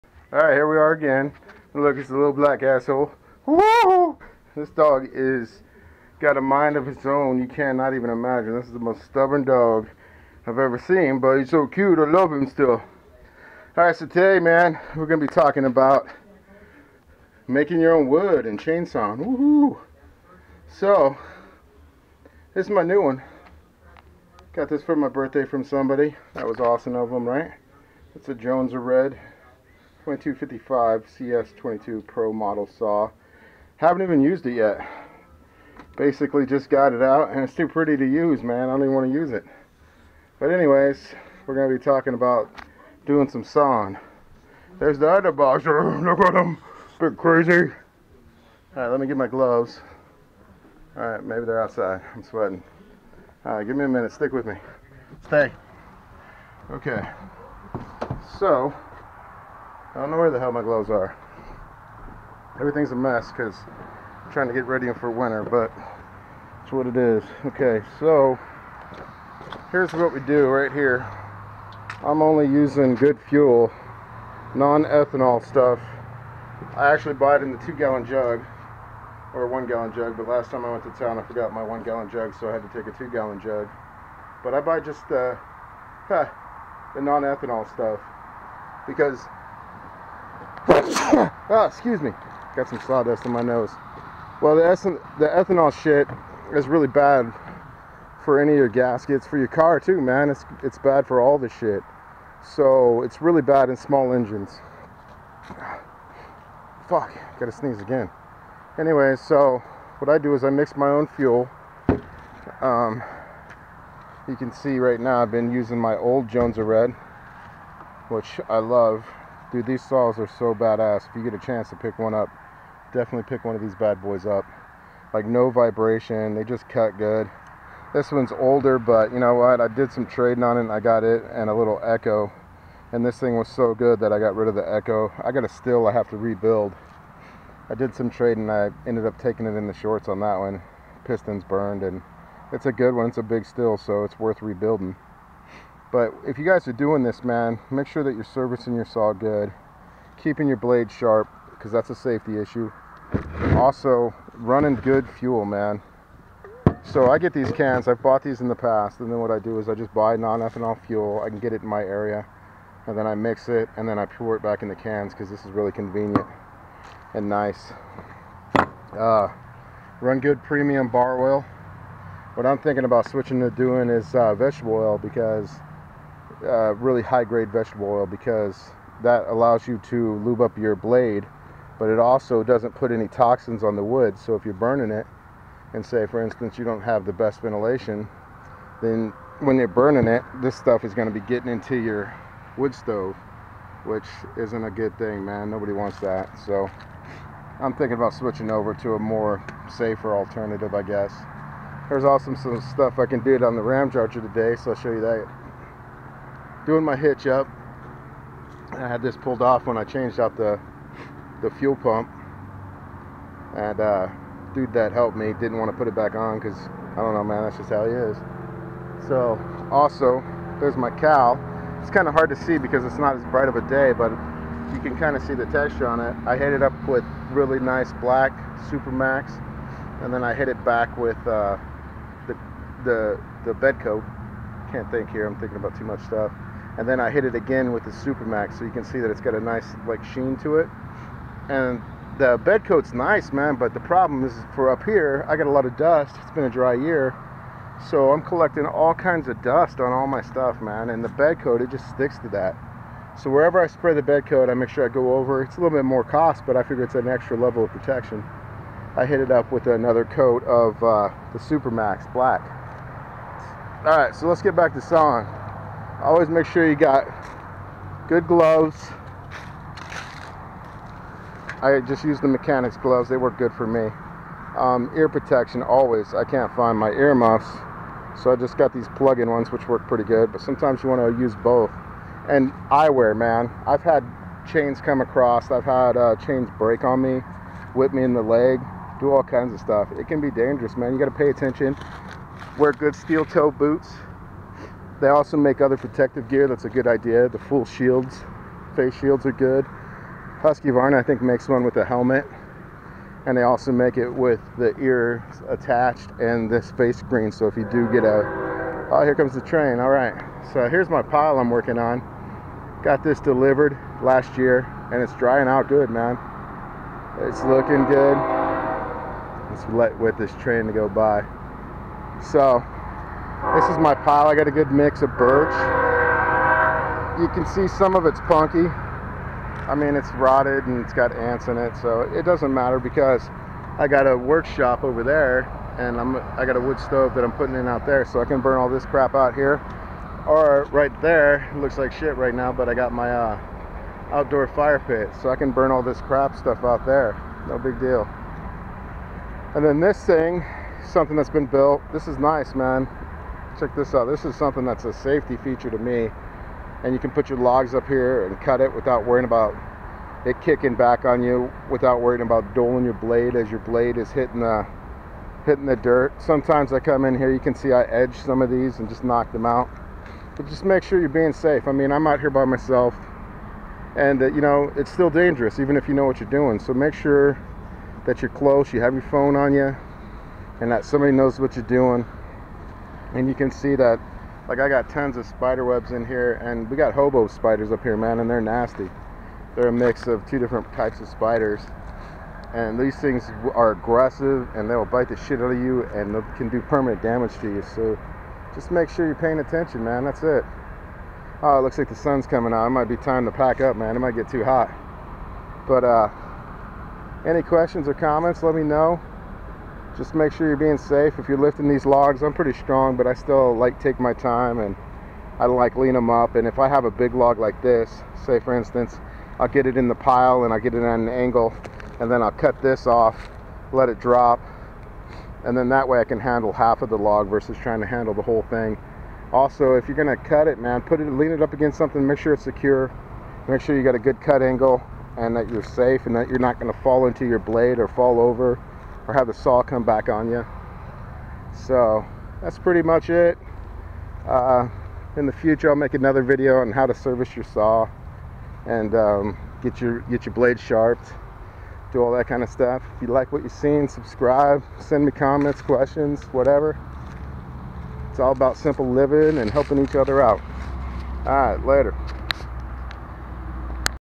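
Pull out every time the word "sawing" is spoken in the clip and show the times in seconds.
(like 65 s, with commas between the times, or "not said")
43 s, 264 s.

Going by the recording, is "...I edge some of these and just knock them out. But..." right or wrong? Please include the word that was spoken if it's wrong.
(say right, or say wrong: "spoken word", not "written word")
right.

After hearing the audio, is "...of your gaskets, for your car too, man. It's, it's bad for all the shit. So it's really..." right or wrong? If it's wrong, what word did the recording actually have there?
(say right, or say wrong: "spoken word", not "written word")
right.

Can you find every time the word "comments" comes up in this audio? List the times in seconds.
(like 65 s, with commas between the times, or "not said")
407 s, 455 s.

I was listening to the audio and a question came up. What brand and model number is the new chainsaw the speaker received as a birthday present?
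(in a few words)
Jonsered 2255.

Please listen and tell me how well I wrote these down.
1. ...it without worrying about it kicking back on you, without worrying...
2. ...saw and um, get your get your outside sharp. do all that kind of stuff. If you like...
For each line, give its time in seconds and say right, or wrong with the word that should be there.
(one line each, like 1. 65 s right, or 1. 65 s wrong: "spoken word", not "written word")
1. 358 s right
2. 447 s wrong: "blade", not "outside".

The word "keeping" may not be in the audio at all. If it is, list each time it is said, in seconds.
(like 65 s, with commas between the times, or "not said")
150 s.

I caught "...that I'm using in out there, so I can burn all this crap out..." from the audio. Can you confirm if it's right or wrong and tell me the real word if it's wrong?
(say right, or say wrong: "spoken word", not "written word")
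wrong: "putting", not "using".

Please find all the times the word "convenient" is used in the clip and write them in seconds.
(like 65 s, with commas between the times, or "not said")
165 s.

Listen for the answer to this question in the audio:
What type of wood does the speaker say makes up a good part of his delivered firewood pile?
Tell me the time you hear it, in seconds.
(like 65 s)
325 s.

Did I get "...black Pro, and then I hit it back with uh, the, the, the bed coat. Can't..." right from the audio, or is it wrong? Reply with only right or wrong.
wrong.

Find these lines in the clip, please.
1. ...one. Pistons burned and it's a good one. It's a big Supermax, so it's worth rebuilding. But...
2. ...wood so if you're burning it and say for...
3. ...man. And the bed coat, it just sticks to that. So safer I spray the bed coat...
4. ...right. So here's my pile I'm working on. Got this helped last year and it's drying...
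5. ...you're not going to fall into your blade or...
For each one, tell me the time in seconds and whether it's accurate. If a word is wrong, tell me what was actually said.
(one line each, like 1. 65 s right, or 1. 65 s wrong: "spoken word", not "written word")
1. 140 s wrong: "Stihl", not "Supermax"
2. 183 s right
3. 250 s wrong: "wherever", not "safer"
4. 309 s wrong: "delivered", not "helped"
5. 436 s right.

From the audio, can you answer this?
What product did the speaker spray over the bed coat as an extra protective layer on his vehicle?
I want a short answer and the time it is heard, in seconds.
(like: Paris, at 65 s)
Supermax black, at 261 s.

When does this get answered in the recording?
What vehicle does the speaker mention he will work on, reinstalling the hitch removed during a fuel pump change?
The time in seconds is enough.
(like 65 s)
203 s.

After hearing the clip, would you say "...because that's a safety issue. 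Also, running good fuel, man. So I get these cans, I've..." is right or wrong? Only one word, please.
right.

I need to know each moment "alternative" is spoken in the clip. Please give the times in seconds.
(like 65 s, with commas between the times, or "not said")
200 s.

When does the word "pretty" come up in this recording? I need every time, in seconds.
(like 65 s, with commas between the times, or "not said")
37 s, 279 s, 412 s, 442 s.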